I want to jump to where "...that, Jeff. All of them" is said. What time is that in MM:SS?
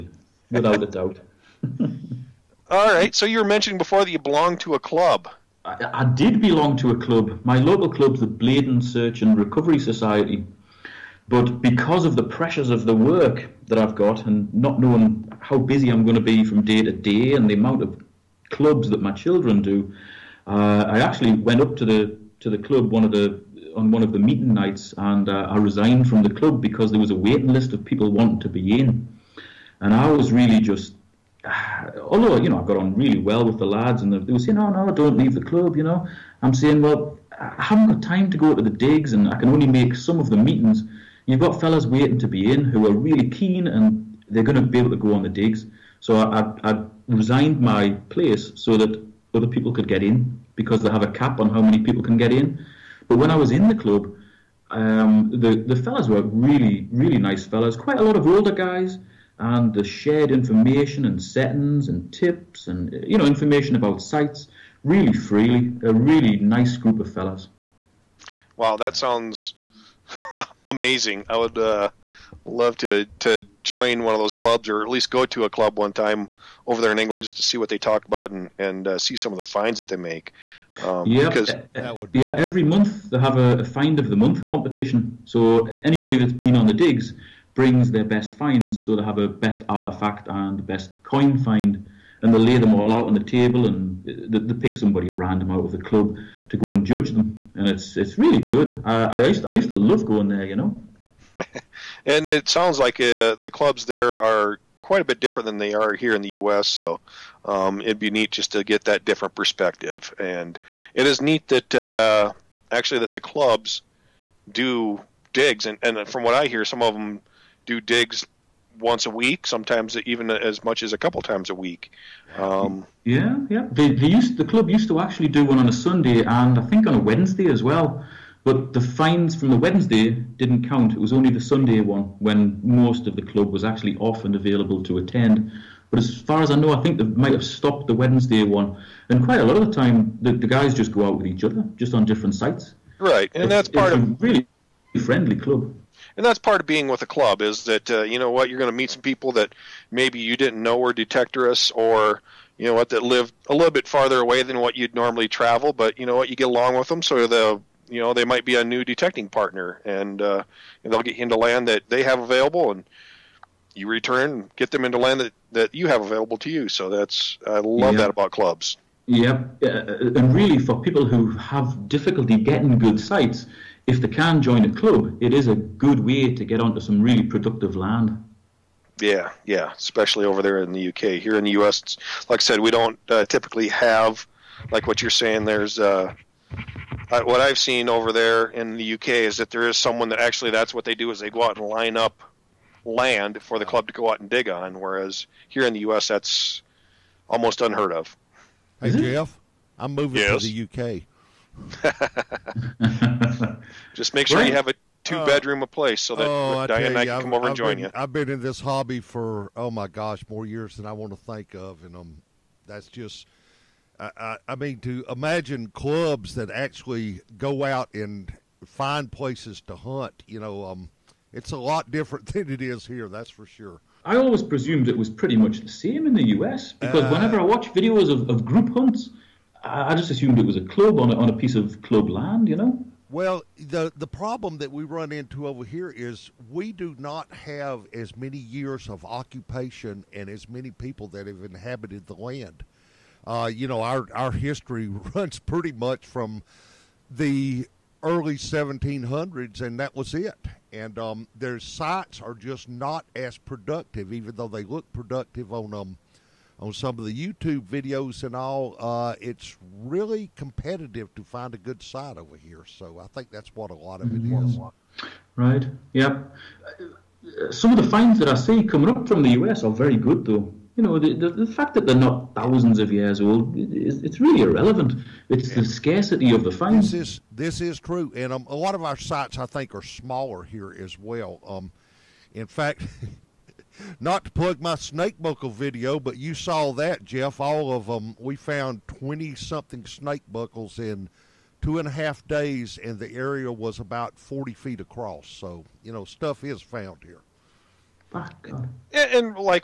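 04:46.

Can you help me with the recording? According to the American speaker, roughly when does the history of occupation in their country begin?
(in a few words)
early 1700s.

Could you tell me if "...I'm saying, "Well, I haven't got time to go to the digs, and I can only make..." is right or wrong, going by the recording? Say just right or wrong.
right.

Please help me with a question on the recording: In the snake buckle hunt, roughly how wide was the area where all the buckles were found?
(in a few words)
40 feet.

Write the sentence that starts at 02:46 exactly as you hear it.
So that's I love that about clubs.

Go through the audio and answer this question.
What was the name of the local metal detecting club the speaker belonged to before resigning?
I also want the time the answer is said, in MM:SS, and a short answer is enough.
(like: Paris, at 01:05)
Bladen Search and Recovery Society, at 00:08.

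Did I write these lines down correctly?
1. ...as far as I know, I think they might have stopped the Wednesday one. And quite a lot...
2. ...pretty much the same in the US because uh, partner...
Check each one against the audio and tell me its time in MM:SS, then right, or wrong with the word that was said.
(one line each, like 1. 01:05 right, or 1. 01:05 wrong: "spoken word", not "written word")
1. 02:16 right
2. 03:45 wrong: "whenever", not "partner".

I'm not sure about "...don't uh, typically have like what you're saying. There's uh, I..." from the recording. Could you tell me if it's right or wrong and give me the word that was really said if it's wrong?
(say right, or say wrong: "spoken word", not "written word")
right.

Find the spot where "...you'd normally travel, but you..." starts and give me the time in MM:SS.
02:34.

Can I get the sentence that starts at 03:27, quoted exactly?
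I've been in this hobby for oh my gosh more years than I want to think of, and um, that's just.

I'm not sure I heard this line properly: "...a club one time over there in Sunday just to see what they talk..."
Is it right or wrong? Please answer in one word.
wrong.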